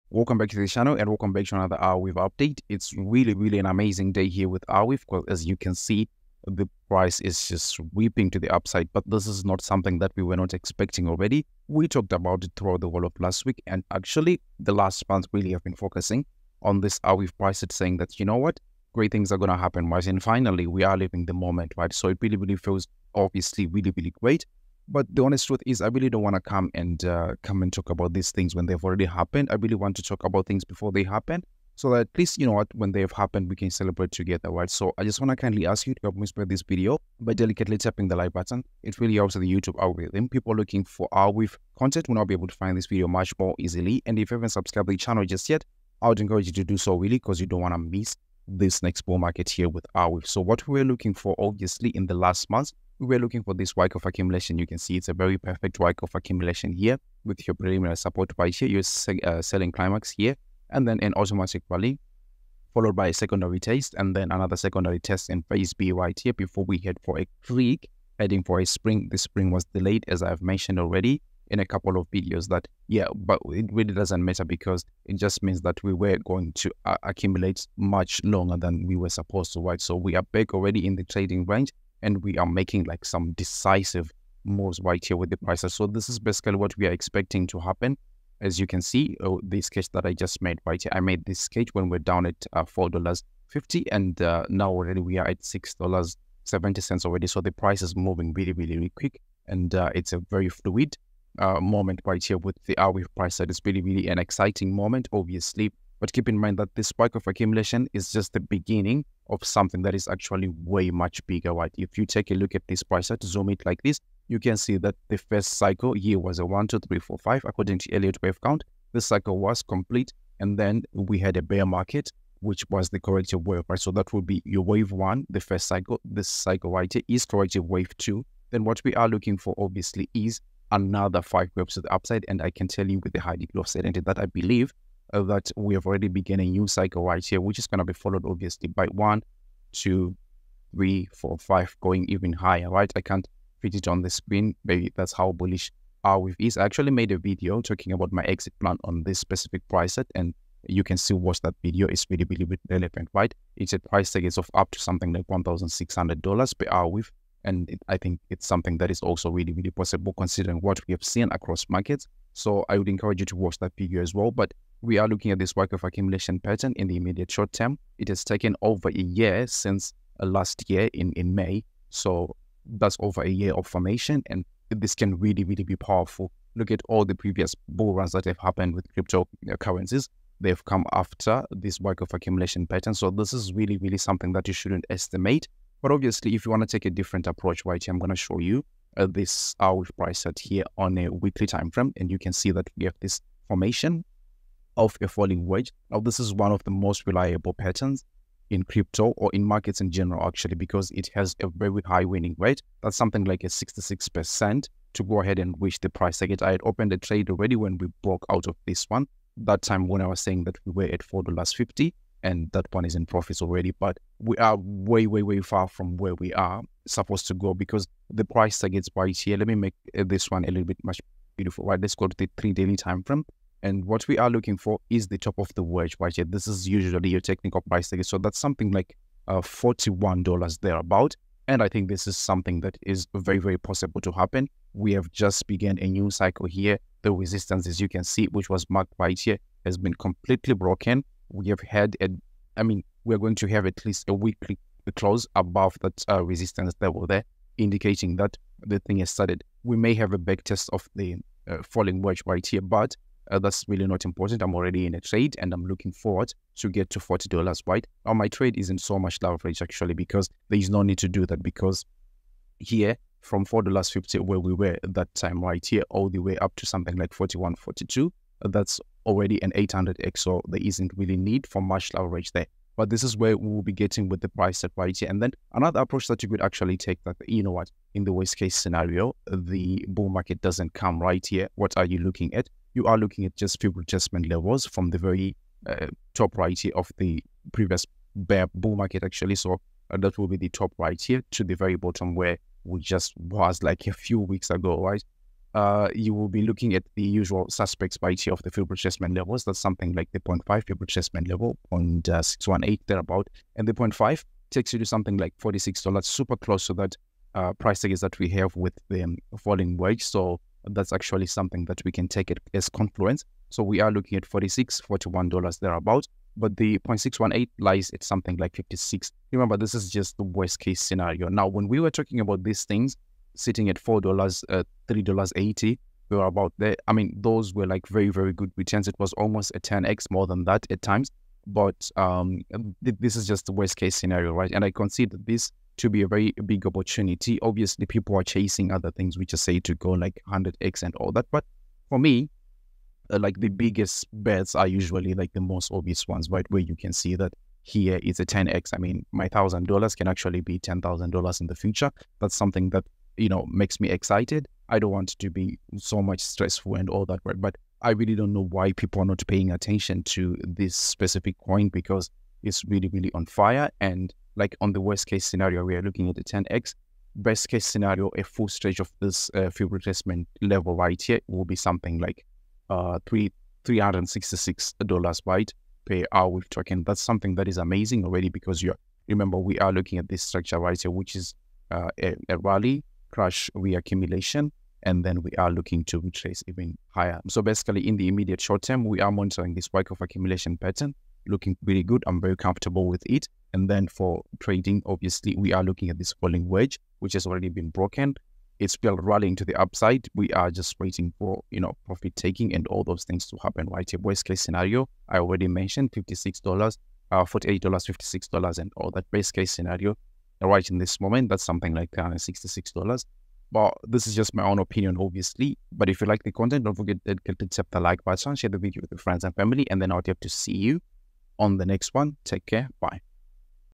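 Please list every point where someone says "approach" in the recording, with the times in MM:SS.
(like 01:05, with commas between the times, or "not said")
03:07, 04:35.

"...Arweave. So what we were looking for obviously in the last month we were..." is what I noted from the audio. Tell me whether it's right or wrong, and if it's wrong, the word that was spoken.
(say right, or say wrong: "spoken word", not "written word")
right.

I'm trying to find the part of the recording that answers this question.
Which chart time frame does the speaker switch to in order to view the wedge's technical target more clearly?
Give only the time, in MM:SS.
03:42.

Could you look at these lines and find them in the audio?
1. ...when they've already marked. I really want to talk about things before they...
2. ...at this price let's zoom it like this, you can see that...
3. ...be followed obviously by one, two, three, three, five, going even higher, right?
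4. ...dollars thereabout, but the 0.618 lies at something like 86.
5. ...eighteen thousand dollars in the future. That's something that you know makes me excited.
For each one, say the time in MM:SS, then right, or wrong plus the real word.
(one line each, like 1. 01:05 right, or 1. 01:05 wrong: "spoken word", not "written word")
1. 00:28 wrong: "happened", not "marked"
2. 01:52 right
3. 02:17 wrong: "four", not "three"
4. 05:15 wrong: "56", not "86"
5. 05:50 wrong: "ten", not "eighteen".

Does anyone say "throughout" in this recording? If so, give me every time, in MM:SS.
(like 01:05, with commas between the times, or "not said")
00:12.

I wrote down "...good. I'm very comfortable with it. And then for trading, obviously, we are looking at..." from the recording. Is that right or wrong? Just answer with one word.
right.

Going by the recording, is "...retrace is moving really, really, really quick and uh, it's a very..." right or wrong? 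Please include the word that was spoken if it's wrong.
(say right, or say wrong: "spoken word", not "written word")
wrong: "price", not "retrace".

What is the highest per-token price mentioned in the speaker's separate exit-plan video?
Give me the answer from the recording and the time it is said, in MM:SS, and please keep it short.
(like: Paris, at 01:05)
$1,600, at 02:35.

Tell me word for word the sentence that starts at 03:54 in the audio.
We have just began a new cycle here.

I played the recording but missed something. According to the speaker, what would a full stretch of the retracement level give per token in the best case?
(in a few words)
$366.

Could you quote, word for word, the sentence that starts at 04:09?
We may have a back test of the uh, falling wedge right here, but uh, that's really not important.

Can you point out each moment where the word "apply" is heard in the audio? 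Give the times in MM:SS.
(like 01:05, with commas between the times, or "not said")
not said.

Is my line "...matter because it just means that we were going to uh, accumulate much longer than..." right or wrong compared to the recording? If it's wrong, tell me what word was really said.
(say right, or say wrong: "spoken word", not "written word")
right.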